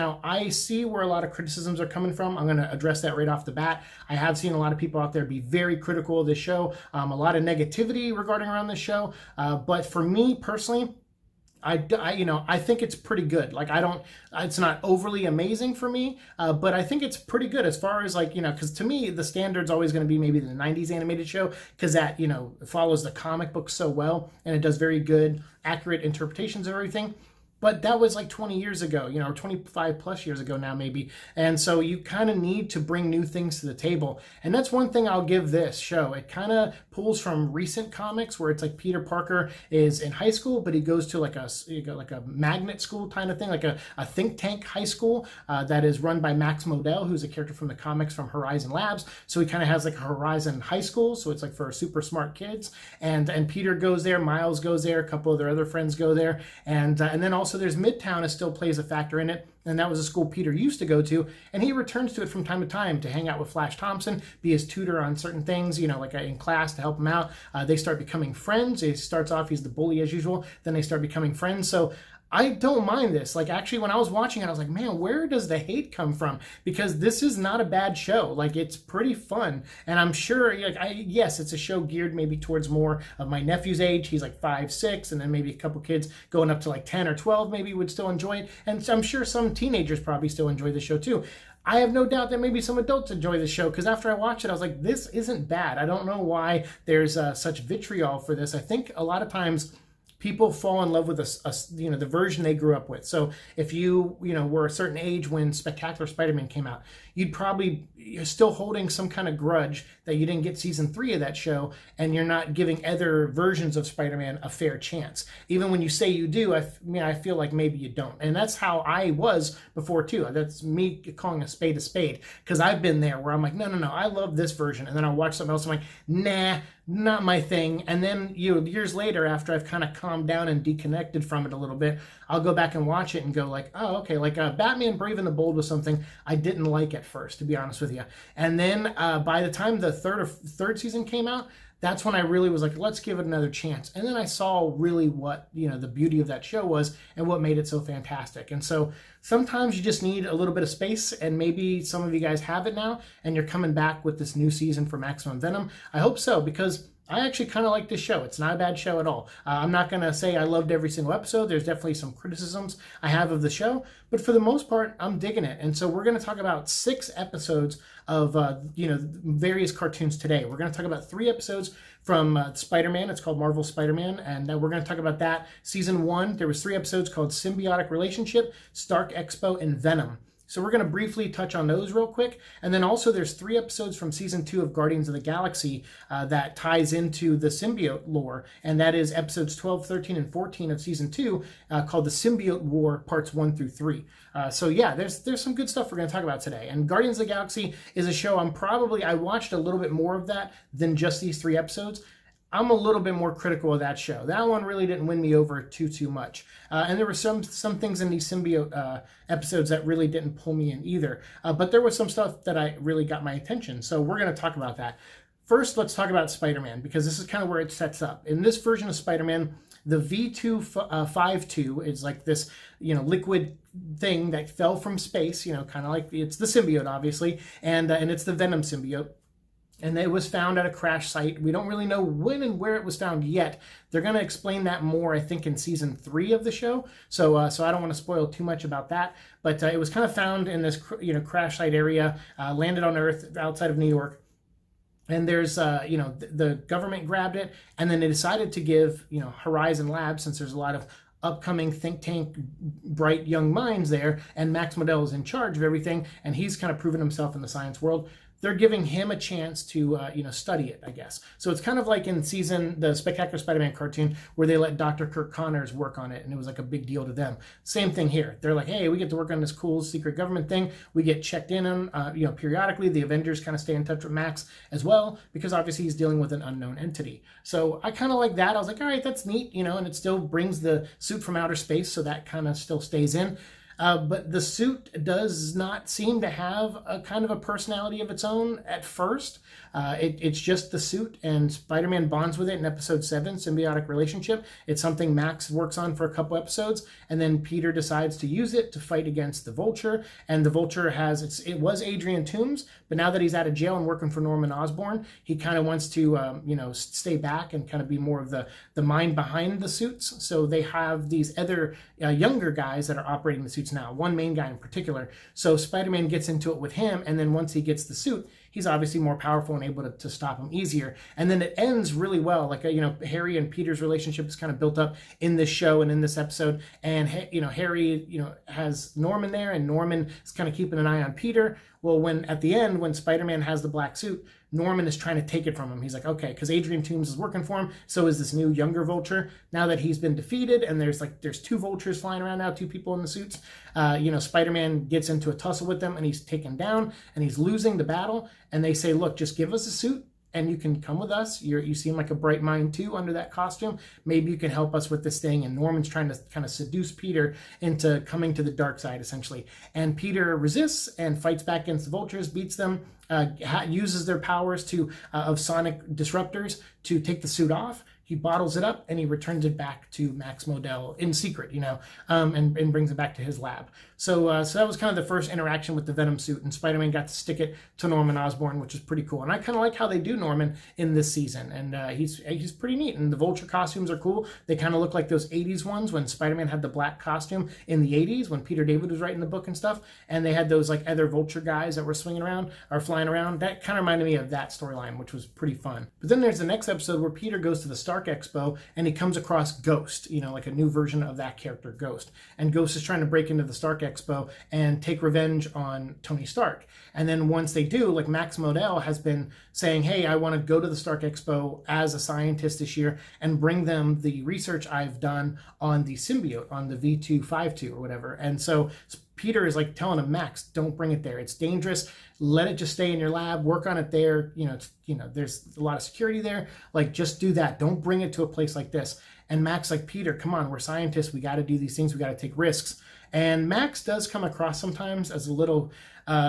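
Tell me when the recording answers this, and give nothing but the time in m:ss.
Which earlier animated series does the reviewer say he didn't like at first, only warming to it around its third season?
2:14.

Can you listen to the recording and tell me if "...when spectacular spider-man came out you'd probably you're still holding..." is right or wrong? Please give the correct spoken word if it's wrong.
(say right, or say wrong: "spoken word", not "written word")
right.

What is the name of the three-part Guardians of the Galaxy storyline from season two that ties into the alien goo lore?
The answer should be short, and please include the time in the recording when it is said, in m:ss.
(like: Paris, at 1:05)
The Symbiote War, at 3:12.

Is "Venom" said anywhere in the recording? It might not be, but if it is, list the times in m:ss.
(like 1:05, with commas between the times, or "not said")
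2:35, 2:59, 3:48, 6:15.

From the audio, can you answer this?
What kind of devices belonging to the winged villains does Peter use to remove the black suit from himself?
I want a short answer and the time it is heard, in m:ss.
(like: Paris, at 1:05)
sonic disruptors, at 6:05.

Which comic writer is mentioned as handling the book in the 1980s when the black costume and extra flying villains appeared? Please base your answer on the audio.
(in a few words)
Peter David.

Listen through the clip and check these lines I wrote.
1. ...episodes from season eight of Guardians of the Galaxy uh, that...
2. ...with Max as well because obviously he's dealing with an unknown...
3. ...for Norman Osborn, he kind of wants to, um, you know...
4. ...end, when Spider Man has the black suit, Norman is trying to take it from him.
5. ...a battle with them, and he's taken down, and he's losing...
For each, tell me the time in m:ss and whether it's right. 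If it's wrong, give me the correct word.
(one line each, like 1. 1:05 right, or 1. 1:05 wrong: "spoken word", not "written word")
1. 3:03 wrong: "two", not "eight"
2. 4:34 right
3. 5:04 right
4. 5:32 right
5. 5:45 wrong: "tussle", not "battle".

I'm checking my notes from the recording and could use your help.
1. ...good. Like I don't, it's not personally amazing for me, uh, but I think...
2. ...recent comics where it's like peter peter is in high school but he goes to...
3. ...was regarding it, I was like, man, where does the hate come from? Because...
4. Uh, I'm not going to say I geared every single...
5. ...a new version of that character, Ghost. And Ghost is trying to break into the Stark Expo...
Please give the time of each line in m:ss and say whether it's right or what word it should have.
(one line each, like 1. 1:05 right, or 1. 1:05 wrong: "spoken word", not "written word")
1. 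0:13 wrong: "overly", not "personally"
2. 0:37 wrong: "parker", not "peter"
3. 1:13 wrong: "watching", not "regarding"
4. 2:39 wrong: "loved", not "geared"
5. 6:40 right.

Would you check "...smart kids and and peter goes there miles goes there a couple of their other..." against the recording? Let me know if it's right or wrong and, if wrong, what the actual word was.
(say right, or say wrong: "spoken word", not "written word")
right.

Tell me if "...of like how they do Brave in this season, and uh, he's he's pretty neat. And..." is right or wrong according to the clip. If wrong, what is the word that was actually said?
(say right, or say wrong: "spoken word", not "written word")
wrong: "Norman", not "Brave".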